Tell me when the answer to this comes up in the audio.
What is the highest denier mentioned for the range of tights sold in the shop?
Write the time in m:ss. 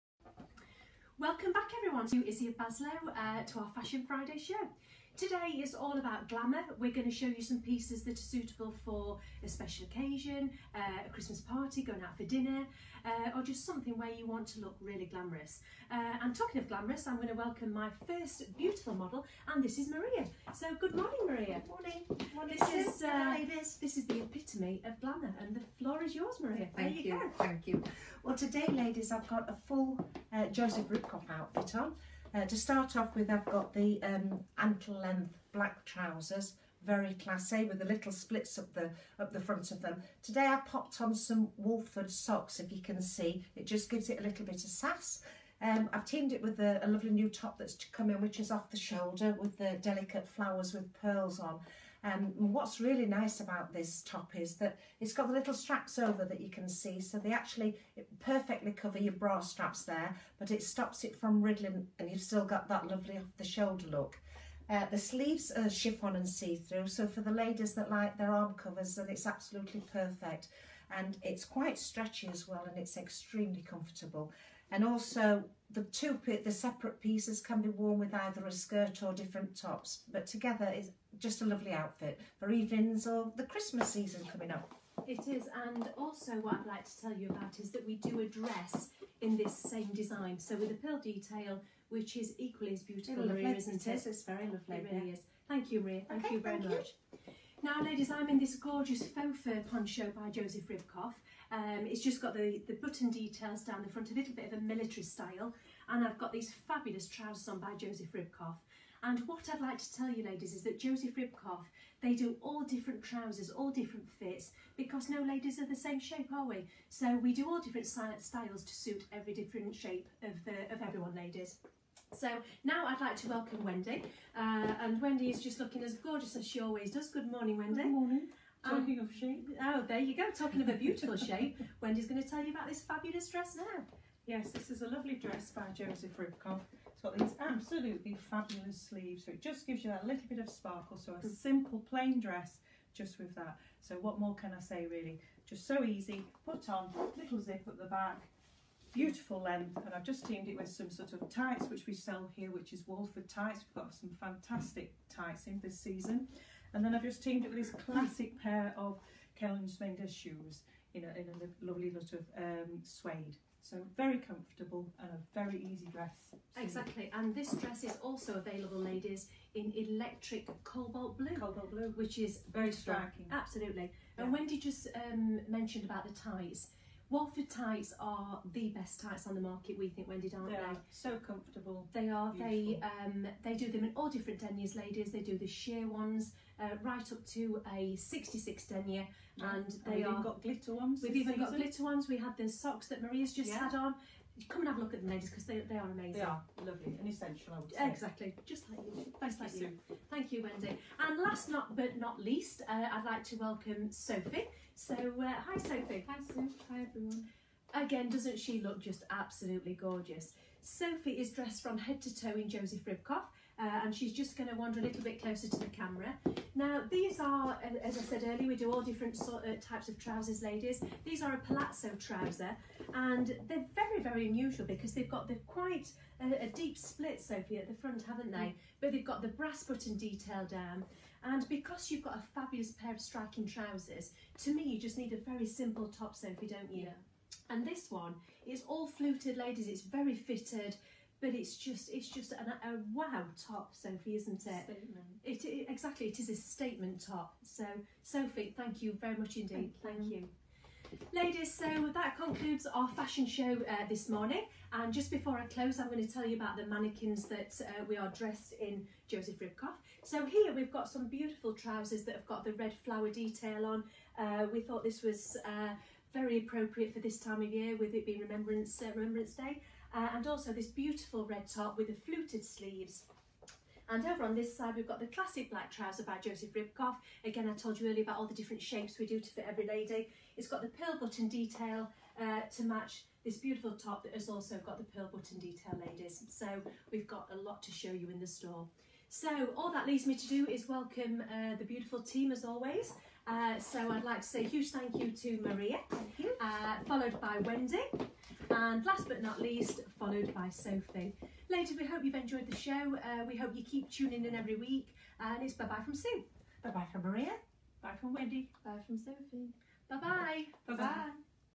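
3:07.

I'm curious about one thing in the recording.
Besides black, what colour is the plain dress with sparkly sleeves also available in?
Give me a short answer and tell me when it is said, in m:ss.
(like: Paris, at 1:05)
Electric cobalt blue, at 2:49.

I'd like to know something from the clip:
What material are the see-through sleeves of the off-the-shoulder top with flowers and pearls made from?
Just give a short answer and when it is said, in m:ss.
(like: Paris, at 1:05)
Chiffon, at 1:05.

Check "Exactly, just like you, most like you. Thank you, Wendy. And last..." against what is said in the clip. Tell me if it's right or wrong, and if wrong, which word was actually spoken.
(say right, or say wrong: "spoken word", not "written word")
right.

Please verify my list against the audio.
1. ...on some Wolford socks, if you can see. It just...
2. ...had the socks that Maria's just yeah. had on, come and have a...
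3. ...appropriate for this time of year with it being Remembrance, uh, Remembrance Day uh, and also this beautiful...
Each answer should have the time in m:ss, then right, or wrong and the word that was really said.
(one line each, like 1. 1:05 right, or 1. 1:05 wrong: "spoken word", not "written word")
1. 0:41 right
2. 3:12 right
3. 4:26 right.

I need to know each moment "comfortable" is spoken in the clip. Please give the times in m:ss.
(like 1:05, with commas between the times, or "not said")
1:13, 2:44, 3:01.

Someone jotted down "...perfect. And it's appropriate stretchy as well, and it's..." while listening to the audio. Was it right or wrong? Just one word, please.
wrong.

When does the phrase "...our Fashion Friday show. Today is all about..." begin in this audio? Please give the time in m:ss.
0:03.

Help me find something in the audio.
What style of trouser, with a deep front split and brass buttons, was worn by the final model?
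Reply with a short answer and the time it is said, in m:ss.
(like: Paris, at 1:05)
Palazzo, at 3:41.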